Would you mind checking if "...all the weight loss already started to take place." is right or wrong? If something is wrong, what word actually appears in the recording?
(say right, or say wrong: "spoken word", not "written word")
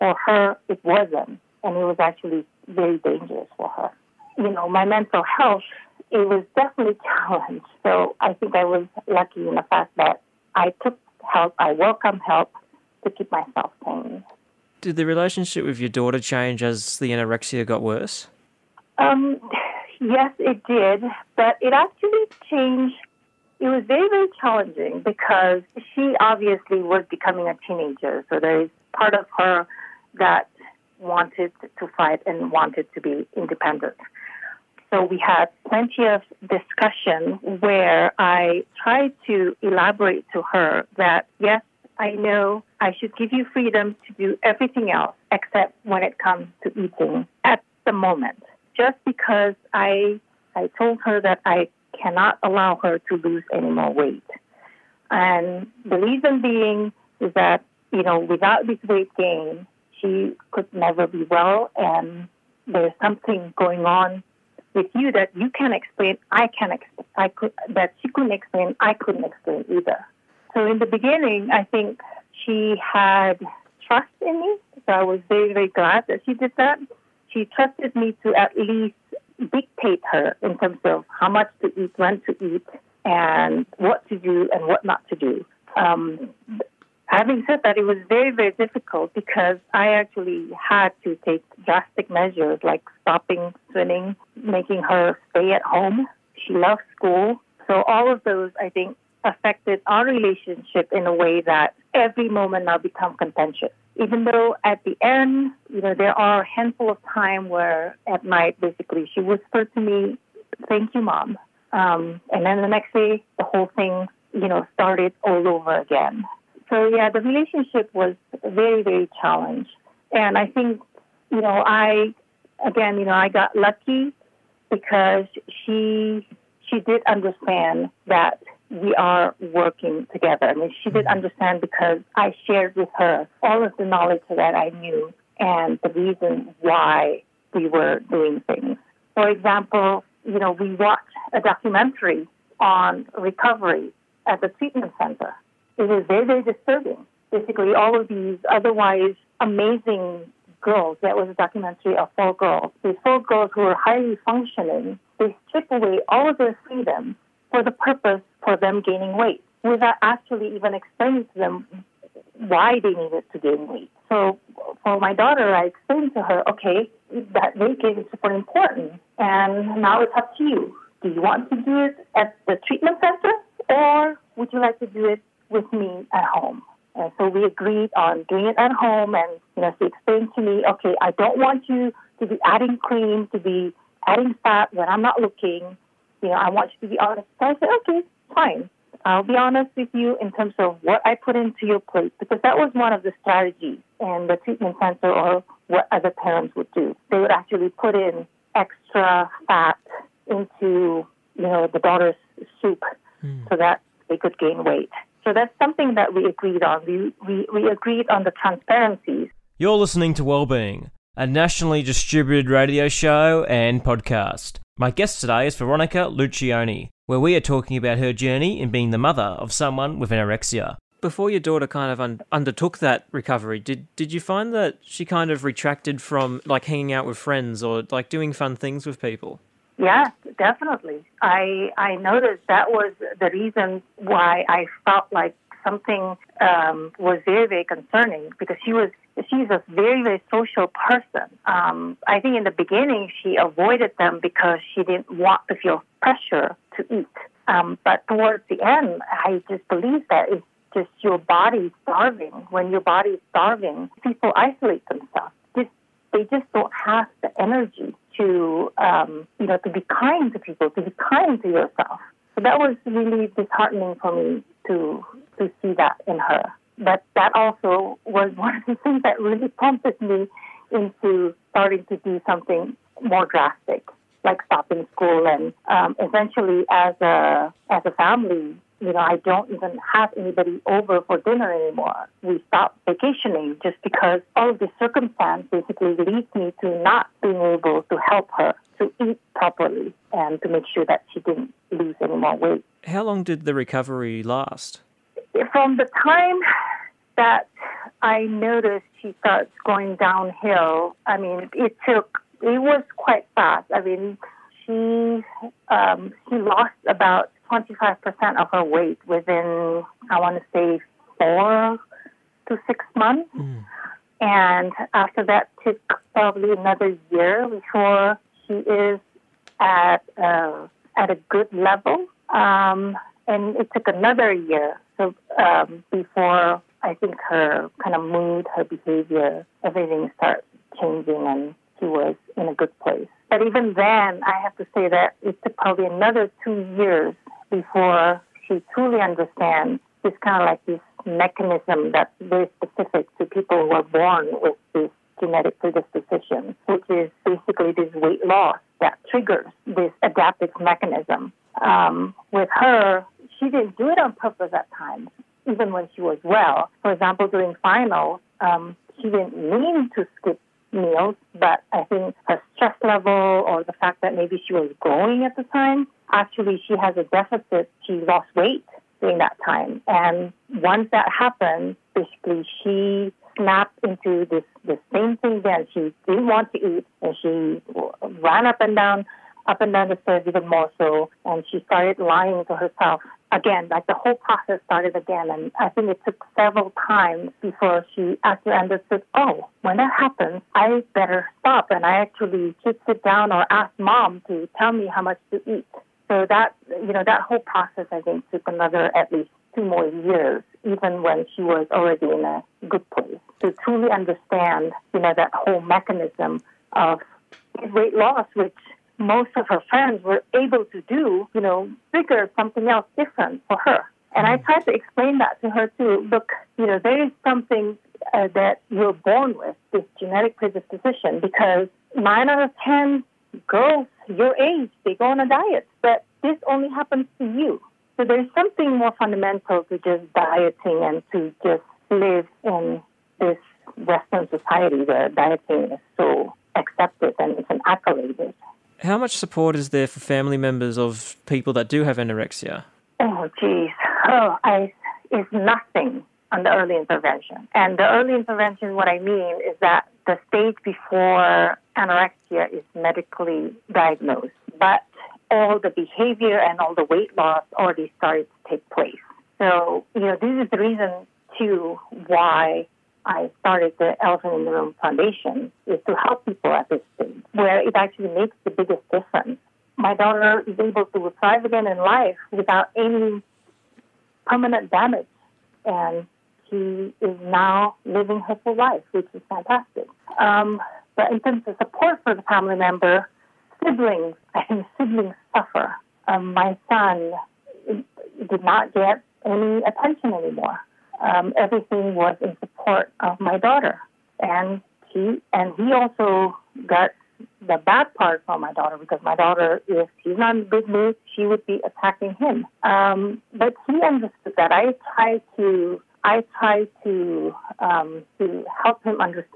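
right.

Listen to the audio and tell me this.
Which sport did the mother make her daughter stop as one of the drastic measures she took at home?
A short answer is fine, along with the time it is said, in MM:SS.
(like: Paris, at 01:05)
swimming, at 01:33.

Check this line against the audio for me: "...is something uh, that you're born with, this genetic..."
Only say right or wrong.
right.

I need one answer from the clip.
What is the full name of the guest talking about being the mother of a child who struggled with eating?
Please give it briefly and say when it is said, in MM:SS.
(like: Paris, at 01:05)
Veronica Luccioni, at 03:35.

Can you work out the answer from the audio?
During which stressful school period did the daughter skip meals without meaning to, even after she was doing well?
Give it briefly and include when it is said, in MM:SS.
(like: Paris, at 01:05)
finals, at 05:57.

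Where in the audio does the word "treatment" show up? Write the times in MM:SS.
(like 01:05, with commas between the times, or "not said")
02:24, 02:52, 03:14.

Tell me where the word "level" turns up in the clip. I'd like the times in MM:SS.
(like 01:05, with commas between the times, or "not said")
05:21, 06:02.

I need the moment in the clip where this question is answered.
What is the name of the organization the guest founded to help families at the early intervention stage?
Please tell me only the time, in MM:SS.
07:44.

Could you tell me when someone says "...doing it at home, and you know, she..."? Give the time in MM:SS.
02:58.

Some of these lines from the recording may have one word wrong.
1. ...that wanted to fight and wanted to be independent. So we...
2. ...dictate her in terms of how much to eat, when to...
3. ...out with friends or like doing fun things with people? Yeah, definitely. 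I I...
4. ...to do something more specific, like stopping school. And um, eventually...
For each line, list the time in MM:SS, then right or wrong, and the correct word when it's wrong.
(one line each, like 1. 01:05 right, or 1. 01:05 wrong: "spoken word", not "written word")
1. 00:30 right
2. 01:19 right
3. 03:46 right
4. 04:31 wrong: "drastic", not "specific".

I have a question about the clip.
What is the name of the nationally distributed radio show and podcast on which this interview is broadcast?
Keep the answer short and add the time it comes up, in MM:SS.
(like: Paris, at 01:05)
Wellbeing, at 03:30.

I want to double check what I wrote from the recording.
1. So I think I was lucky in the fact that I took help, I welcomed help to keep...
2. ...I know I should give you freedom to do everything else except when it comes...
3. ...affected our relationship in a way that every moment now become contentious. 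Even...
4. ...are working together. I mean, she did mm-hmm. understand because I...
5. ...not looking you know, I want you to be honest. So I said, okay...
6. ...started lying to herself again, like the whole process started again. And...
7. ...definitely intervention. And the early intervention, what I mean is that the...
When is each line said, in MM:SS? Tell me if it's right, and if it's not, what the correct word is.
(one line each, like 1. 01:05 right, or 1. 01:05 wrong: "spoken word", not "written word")
1. 00:07 right
2. 00:42 right
3. 01:39 right
4. 02:08 right
5. 03:05 right
6. 06:21 right
7. 07:26 wrong: "early", not "definitely".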